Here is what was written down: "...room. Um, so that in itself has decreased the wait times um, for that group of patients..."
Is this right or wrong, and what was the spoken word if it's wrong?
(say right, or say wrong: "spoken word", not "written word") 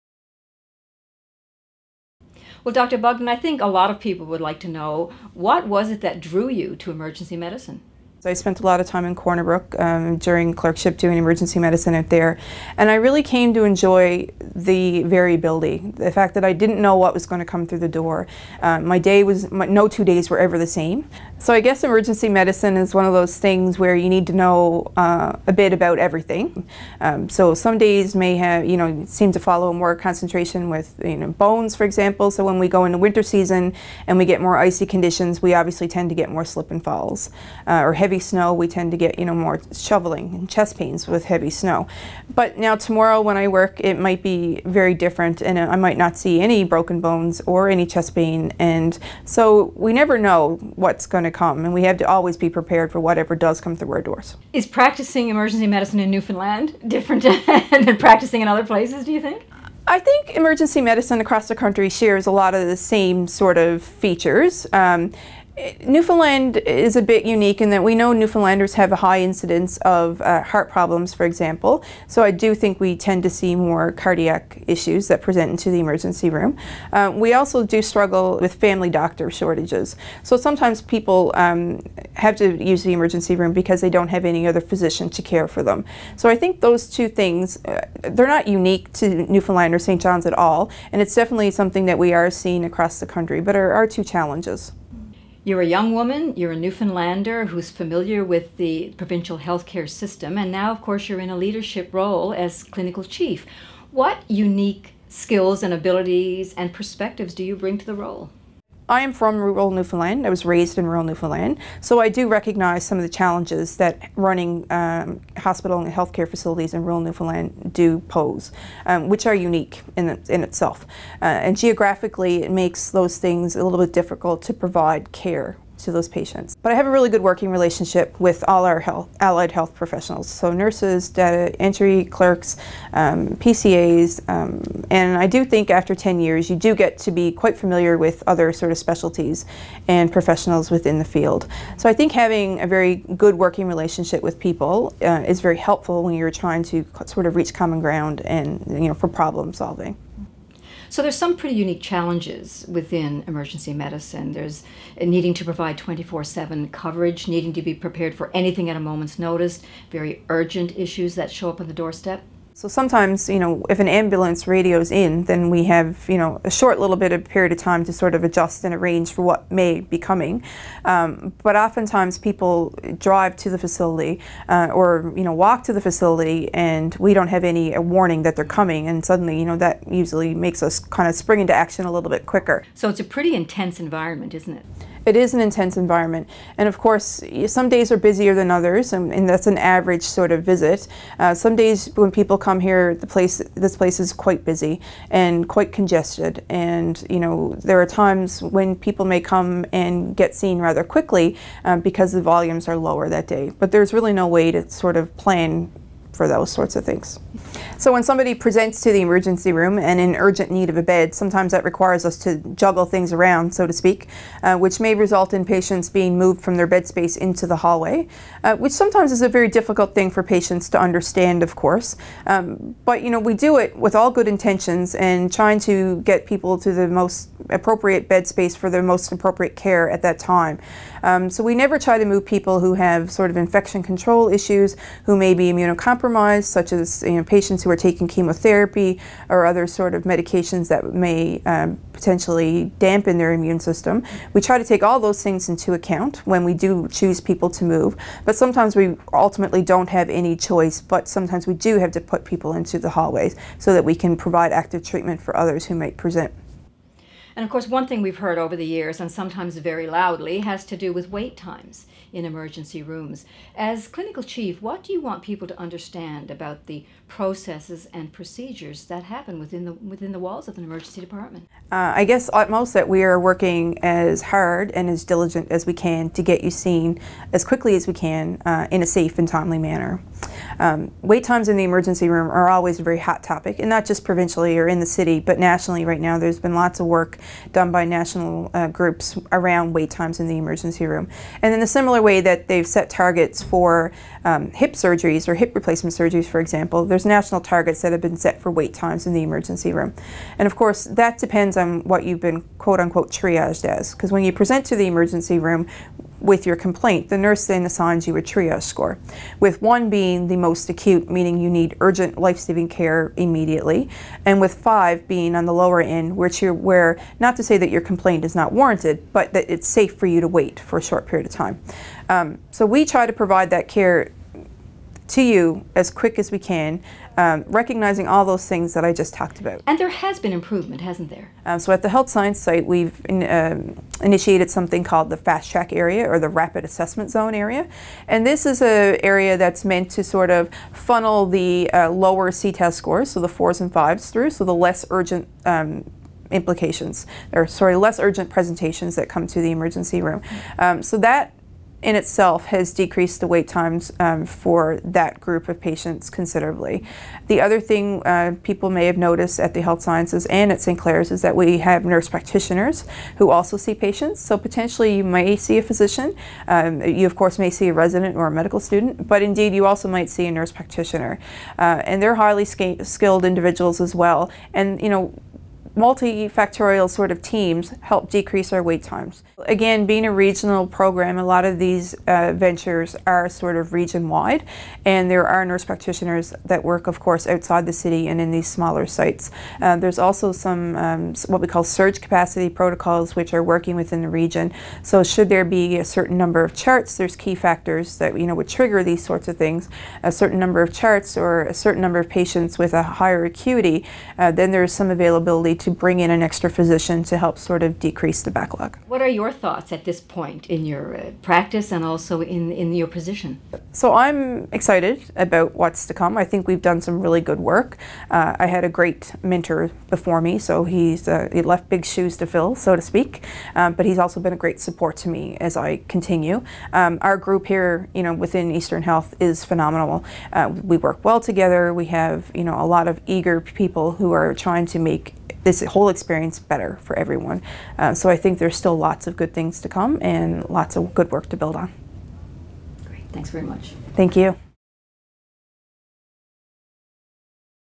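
right.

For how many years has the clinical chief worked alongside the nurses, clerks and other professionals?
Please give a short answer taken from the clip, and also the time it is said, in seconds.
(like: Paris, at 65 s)
10 years, at 135 s.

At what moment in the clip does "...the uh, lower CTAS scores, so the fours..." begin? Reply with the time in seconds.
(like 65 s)
341 s.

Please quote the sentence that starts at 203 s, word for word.
But there's really no way to sort of plan for those sorts of things.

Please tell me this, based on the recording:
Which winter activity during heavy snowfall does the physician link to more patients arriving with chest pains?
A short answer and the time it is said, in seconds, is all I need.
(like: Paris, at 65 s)
shoveling, at 39 s.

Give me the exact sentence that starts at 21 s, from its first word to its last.
So I guess emergency medicine is one of those things where you need to know uh, a bit about everything.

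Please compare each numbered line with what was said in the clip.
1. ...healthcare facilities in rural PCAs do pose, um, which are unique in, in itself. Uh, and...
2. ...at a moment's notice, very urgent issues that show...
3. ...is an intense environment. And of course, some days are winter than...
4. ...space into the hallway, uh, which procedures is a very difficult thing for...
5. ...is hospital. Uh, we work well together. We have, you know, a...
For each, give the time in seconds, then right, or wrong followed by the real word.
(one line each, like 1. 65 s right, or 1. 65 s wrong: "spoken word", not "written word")
1. 115 s wrong: "Newfoundland", not "PCAs"
2. 158 s right
3. 185 s wrong: "busier", not "winter"
4. 216 s wrong: "sometimes", not "procedures"
5. 429 s wrong: "phenomenal", not "hospital".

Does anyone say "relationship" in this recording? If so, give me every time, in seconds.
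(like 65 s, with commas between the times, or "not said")
127 s, 143 s.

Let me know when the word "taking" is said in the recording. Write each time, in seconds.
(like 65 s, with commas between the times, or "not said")
237 s.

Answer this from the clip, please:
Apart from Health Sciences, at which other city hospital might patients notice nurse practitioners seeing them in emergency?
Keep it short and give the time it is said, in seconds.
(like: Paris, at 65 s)
St. Clare's, at 360 s.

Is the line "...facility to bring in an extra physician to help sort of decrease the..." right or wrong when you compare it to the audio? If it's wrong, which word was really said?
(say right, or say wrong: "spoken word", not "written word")
wrong: "availability", not "facility".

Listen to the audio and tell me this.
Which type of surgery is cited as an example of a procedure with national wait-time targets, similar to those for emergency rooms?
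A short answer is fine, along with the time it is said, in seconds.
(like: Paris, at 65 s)
hip replacement, at 295 s.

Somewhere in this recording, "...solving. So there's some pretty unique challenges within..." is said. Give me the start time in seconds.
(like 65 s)
149 s.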